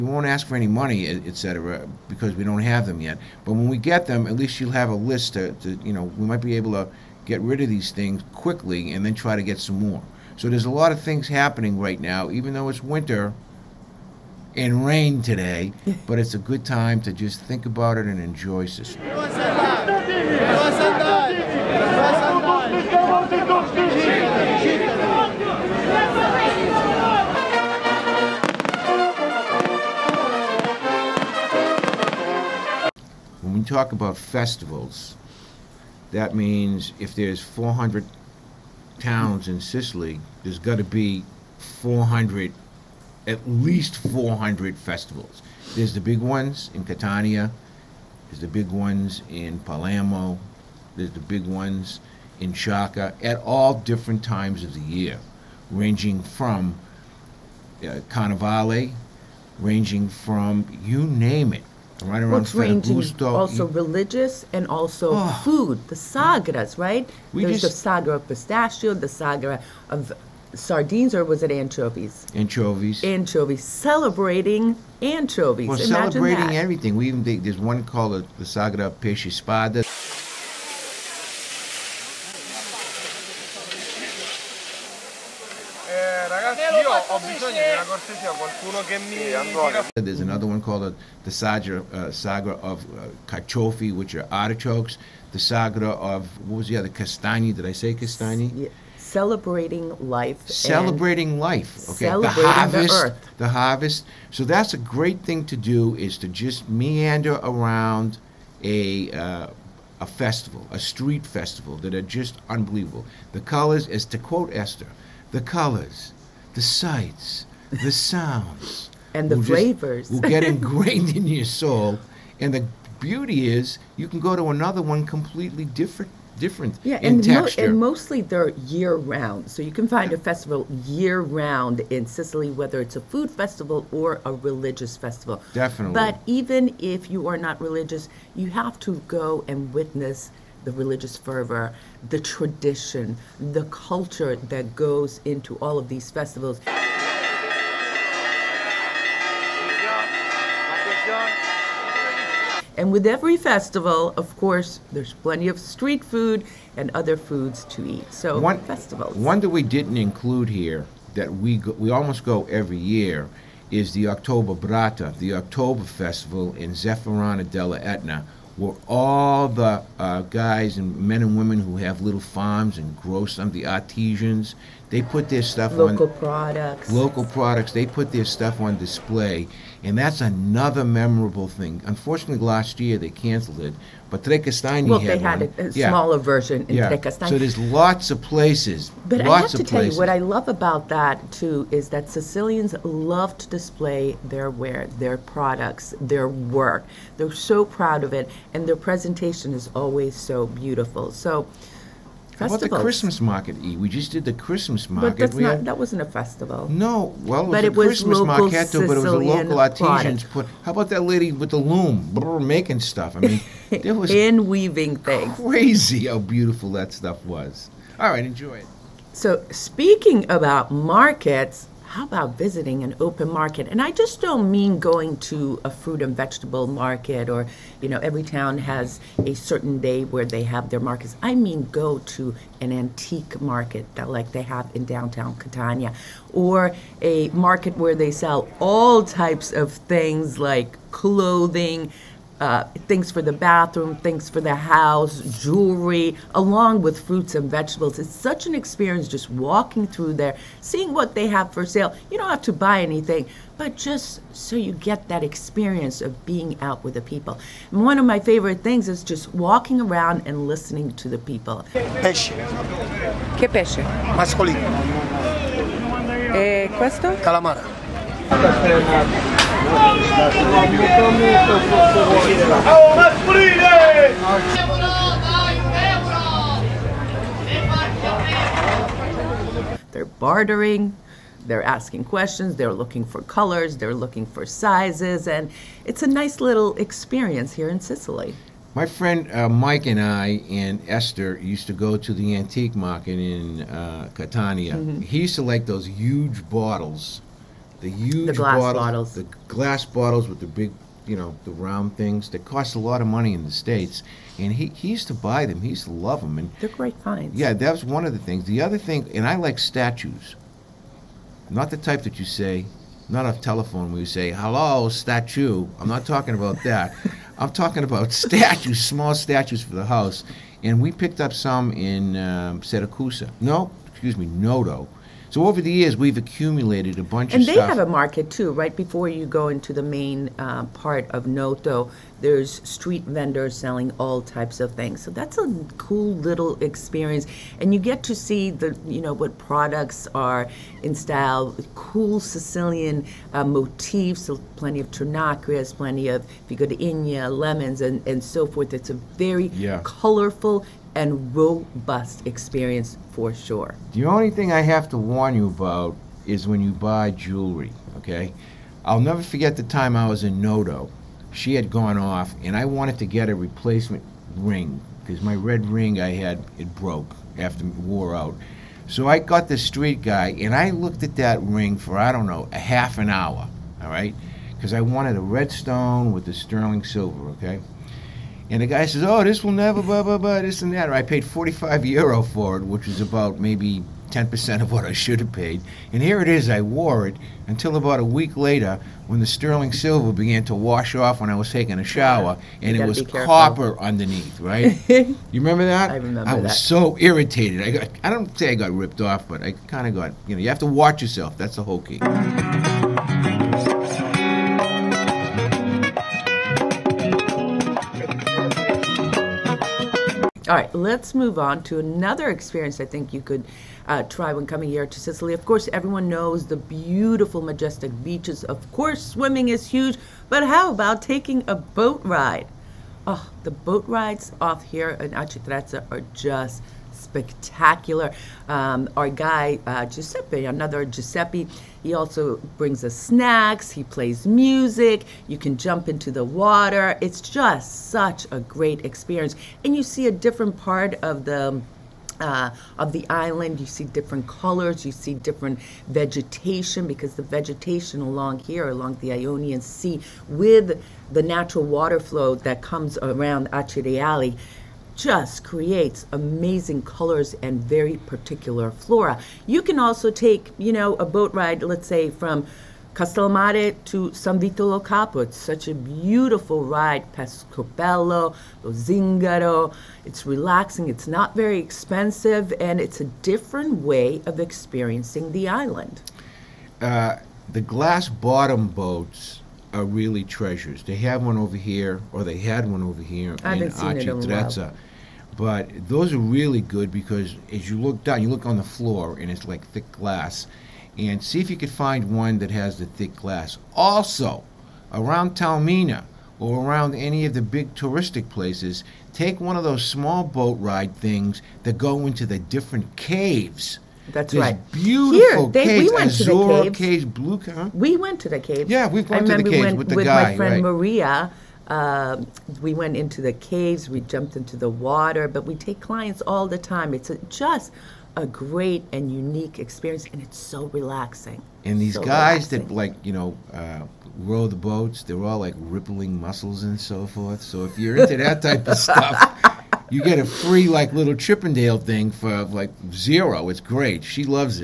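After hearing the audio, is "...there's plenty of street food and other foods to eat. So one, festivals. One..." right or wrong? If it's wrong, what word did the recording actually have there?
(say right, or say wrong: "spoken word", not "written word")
right.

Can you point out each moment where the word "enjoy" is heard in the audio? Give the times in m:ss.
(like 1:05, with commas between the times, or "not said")
0:18, 3:38.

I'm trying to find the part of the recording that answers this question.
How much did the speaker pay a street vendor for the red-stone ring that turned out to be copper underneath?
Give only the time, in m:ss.
6:21.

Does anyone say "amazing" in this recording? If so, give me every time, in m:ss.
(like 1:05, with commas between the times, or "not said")
7:36.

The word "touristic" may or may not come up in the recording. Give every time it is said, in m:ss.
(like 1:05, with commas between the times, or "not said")
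8:17.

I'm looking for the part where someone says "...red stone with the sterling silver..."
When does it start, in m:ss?
6:15.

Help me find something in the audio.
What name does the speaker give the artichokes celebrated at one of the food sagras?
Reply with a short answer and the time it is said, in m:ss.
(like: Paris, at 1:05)
Kachofi, at 1:33.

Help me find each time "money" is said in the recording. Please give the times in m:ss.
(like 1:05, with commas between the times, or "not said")
0:00, 5:03.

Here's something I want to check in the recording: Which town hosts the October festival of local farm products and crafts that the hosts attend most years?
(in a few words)
Zafferana della Etna.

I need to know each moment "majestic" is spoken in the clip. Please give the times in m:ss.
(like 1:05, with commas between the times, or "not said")
6:57.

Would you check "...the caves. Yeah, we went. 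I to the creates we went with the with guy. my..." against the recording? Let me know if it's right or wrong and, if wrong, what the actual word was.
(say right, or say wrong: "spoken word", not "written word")
wrong: "caves", not "creates".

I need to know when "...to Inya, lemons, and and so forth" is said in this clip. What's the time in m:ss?
5:46.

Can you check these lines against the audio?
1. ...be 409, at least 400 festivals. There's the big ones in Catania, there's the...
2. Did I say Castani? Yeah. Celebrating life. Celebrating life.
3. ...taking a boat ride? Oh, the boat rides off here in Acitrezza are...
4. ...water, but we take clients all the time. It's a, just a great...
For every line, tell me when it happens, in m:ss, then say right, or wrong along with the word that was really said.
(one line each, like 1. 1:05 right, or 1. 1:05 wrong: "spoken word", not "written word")
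1. 0:40 wrong: "400", not "409"
2. 1:37 right
3. 7:01 right
4. 8:34 right.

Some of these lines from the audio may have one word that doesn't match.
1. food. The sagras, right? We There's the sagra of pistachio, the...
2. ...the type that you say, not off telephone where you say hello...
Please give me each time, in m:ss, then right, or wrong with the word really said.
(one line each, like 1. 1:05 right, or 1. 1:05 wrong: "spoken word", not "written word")
1. 1:05 right
2. 5:11 right.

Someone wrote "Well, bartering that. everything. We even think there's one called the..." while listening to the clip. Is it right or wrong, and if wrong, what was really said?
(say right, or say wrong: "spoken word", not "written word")
wrong: "celebrating", not "bartering".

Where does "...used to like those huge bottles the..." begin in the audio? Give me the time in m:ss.
4:55.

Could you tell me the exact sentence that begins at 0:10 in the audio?
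So there's a lot of things happening right now, even though it's winter and rain today.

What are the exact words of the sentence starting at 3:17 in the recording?
They're so proud of it, and their presentation is always so beautiful.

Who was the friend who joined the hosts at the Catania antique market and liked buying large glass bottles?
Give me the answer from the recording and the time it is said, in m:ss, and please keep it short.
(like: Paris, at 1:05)
Mike, at 4:49.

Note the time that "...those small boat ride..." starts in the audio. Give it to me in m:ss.
8:19.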